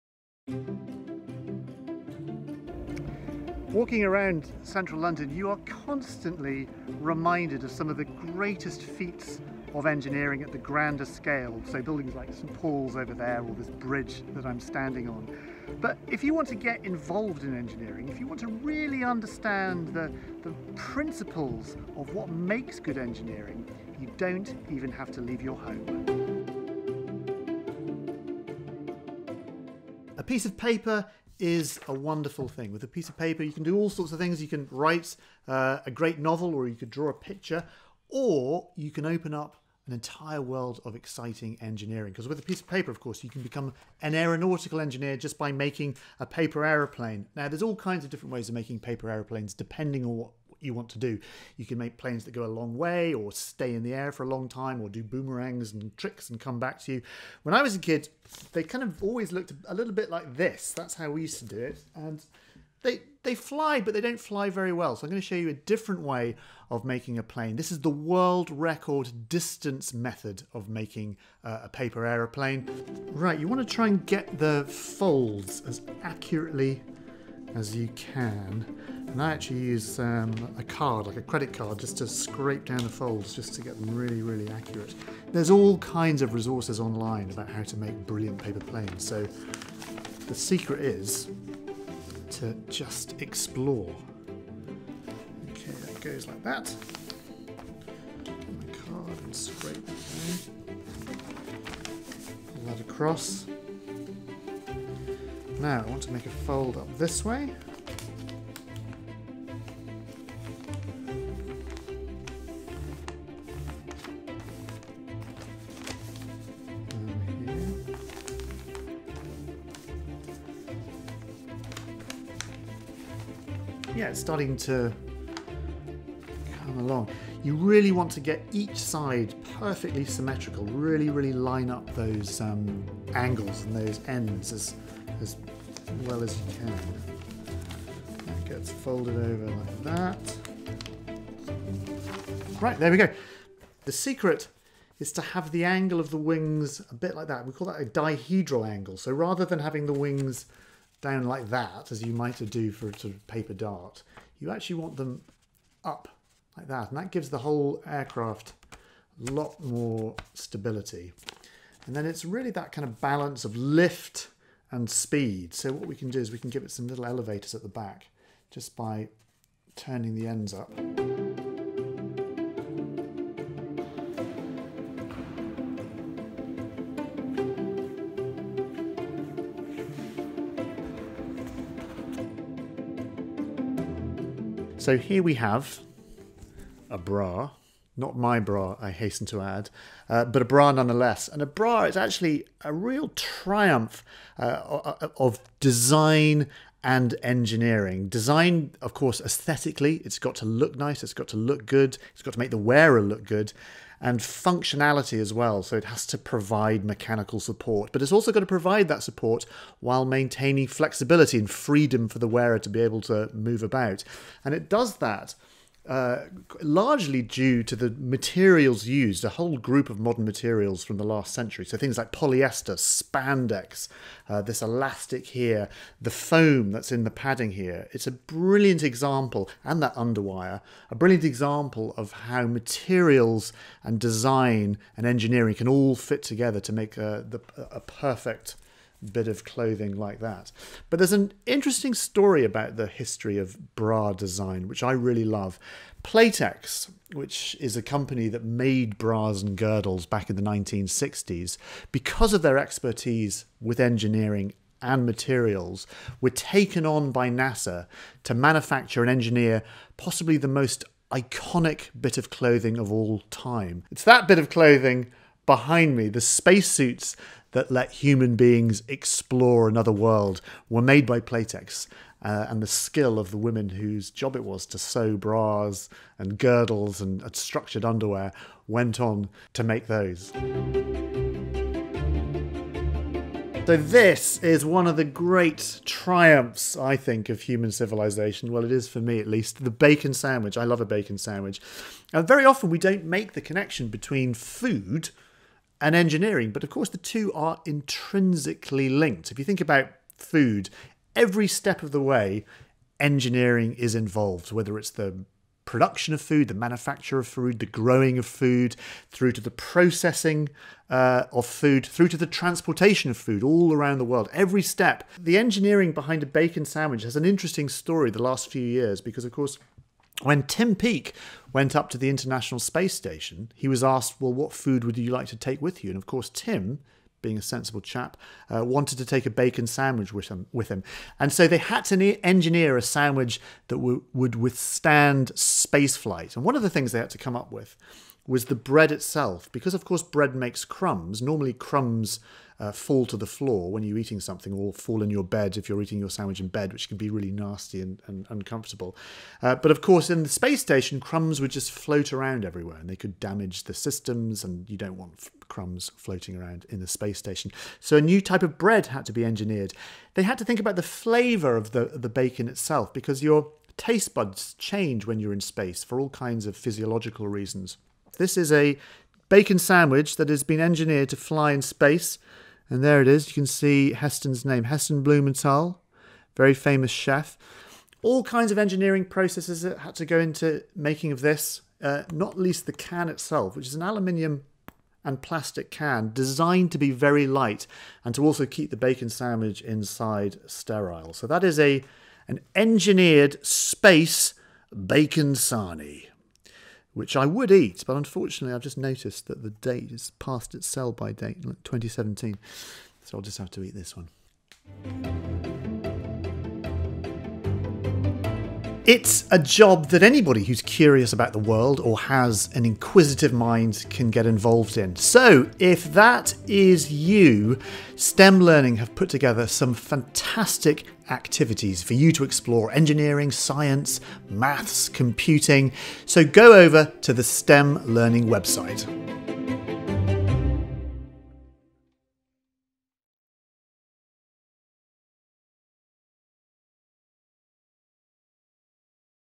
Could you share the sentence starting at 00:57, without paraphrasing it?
When I was a kid, they kind of always looked a little bit like this.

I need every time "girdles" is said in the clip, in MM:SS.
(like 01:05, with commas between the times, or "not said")
04:09, 04:36.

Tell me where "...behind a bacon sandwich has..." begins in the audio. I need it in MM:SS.
05:15.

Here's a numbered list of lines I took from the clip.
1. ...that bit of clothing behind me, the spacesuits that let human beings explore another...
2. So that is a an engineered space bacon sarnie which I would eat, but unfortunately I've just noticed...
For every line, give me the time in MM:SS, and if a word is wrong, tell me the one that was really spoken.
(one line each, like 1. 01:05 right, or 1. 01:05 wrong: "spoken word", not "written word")
1. 04:24 right
2. 06:31 right.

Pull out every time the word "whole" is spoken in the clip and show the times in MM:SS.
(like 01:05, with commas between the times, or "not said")
02:37, 03:39.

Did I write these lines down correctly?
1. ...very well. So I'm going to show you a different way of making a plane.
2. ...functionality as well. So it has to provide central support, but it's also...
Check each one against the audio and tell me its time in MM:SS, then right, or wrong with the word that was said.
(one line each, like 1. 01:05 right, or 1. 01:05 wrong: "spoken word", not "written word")
1. 01:04 right
2. 03:24 wrong: "mechanical", not "central".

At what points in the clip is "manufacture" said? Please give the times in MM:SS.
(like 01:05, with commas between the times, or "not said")
04:18, 05:06.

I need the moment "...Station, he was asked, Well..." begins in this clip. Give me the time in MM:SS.
05:22.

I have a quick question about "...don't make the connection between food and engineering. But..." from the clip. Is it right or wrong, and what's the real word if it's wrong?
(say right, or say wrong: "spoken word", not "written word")
right.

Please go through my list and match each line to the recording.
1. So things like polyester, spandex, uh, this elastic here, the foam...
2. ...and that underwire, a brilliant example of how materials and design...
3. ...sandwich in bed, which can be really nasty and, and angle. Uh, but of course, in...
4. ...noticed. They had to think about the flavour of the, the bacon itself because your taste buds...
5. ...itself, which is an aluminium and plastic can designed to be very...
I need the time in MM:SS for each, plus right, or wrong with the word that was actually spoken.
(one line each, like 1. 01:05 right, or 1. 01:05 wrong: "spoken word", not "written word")
1. 03:41 right
2. 03:49 right
3. 05:46 wrong: "uncomfortable", not "angle"
4. 05:59 wrong: "engineered", not "noticed"
5. 06:23 right.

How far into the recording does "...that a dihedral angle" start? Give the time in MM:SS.
02:27.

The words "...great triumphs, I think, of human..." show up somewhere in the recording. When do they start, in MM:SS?
04:45.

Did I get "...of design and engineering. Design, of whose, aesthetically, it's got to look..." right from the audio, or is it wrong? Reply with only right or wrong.
wrong.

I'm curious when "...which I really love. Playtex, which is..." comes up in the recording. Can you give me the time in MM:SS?
04:04.